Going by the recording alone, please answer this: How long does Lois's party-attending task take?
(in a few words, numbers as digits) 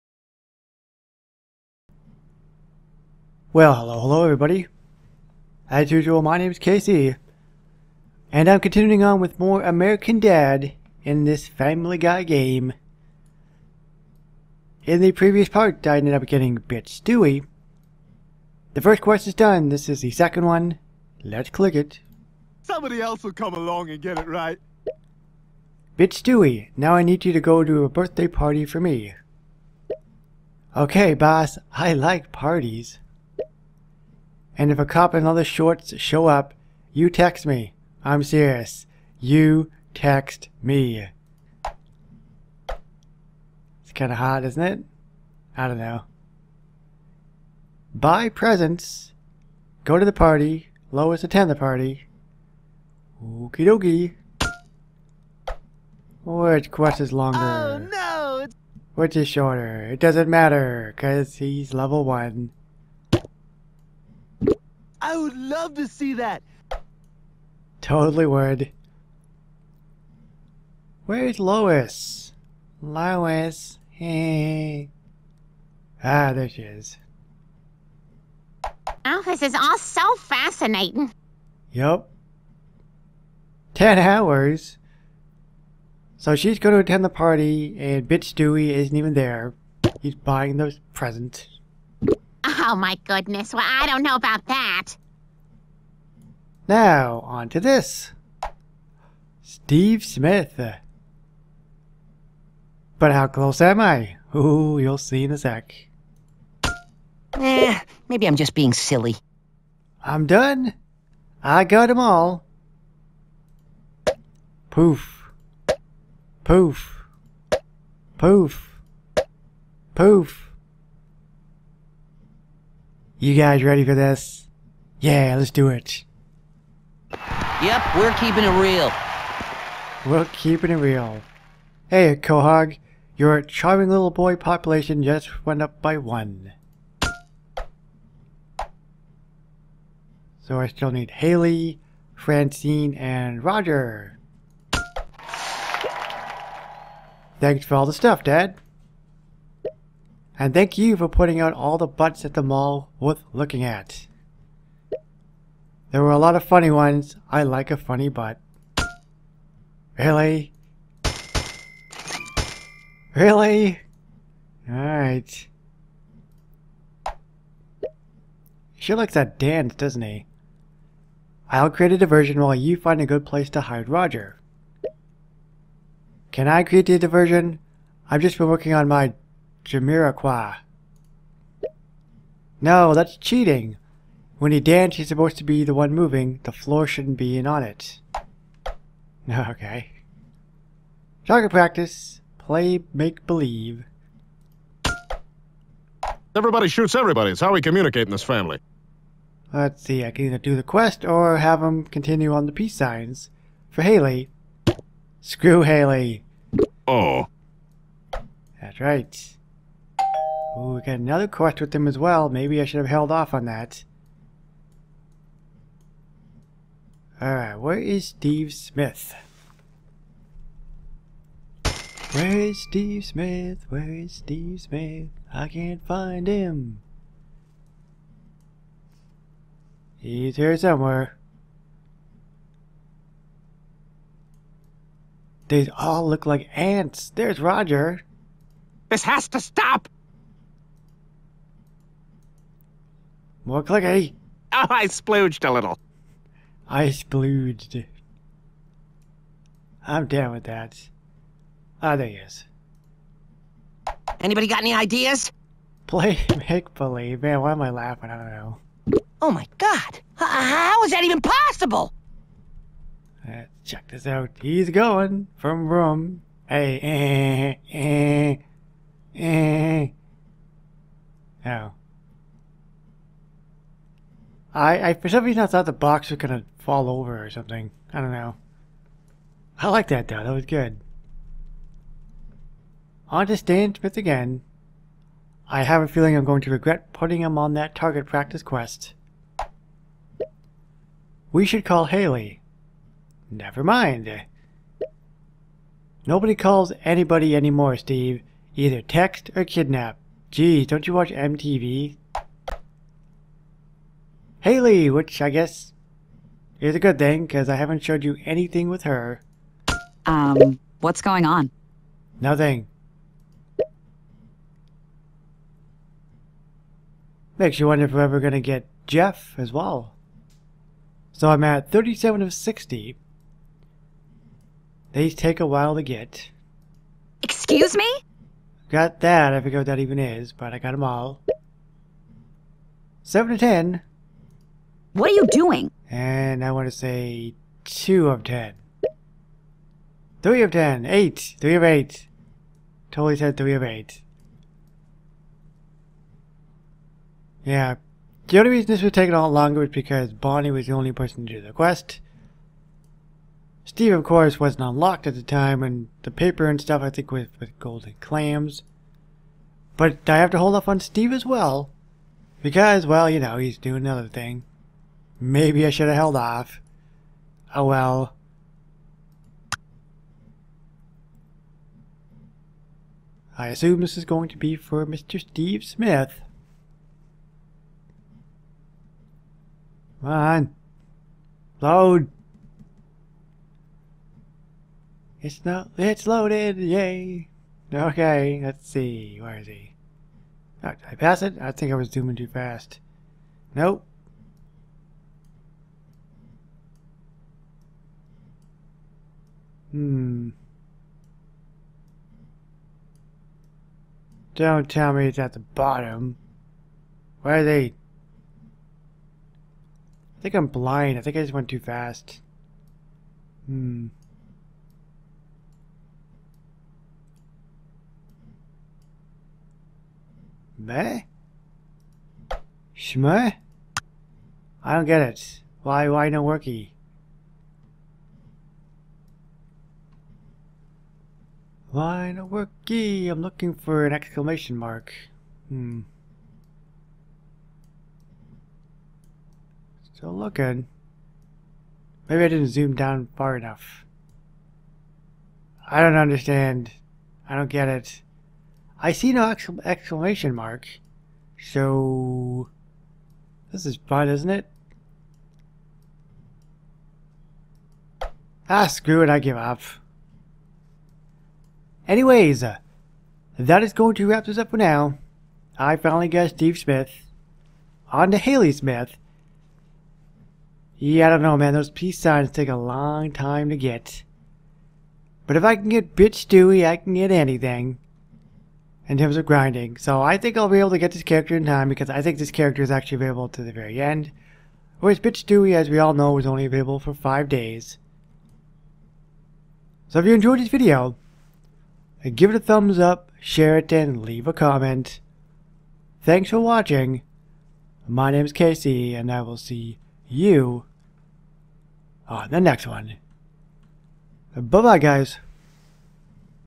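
10 hours.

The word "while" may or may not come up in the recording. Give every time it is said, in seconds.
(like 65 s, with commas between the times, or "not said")
172 s, 325 s.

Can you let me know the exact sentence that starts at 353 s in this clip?
Steve, of course, wasn't unlocked at the time, and the paper and stuff, I think, was with golden clams.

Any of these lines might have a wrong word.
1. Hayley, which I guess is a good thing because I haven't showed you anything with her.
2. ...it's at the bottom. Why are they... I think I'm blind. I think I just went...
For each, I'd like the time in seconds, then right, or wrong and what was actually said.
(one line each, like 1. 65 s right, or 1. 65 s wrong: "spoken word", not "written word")
1. 304 s right
2. 405 s right.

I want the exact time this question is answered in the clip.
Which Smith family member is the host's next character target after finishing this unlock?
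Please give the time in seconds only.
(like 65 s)
468 s.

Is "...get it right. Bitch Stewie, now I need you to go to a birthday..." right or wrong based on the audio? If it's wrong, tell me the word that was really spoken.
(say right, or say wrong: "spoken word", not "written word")
right.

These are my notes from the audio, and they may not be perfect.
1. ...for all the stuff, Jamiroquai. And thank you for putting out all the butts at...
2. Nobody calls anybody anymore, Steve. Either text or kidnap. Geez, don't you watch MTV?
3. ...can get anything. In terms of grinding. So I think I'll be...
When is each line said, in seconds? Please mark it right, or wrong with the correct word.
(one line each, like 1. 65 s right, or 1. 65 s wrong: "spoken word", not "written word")
1. 147 s wrong: "Dad", not "Jamiroquai"
2. 296 s right
3. 476 s right.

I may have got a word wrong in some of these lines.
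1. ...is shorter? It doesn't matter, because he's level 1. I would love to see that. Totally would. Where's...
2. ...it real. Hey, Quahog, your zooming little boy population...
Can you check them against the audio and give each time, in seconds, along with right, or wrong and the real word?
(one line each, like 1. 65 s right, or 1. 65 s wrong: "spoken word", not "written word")
1. 59 s right
2. 130 s wrong: "charming", not "zooming".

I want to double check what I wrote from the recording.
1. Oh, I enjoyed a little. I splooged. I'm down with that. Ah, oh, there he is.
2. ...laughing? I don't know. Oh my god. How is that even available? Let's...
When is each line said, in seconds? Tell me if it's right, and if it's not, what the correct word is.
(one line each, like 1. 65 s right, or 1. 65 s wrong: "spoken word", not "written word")
1. 244 s wrong: "splooged", not "enjoyed"
2. 257 s wrong: "possible", not "available".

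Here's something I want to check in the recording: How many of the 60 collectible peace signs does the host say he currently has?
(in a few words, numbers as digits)
37.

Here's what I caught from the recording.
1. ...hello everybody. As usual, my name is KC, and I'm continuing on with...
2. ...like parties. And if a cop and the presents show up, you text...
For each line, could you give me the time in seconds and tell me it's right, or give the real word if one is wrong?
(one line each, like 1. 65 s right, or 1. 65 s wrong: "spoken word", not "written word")
1. 3 s right
2. 31 s wrong: "shorts", not "presents".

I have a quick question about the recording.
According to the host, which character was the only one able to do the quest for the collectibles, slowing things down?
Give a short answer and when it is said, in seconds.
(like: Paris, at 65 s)
Bonnie, at 350 s.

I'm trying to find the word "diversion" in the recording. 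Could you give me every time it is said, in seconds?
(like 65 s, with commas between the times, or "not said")
171 s, 176 s.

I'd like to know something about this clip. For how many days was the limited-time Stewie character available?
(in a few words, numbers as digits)
5.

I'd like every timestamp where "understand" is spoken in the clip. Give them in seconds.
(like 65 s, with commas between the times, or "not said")
445 s.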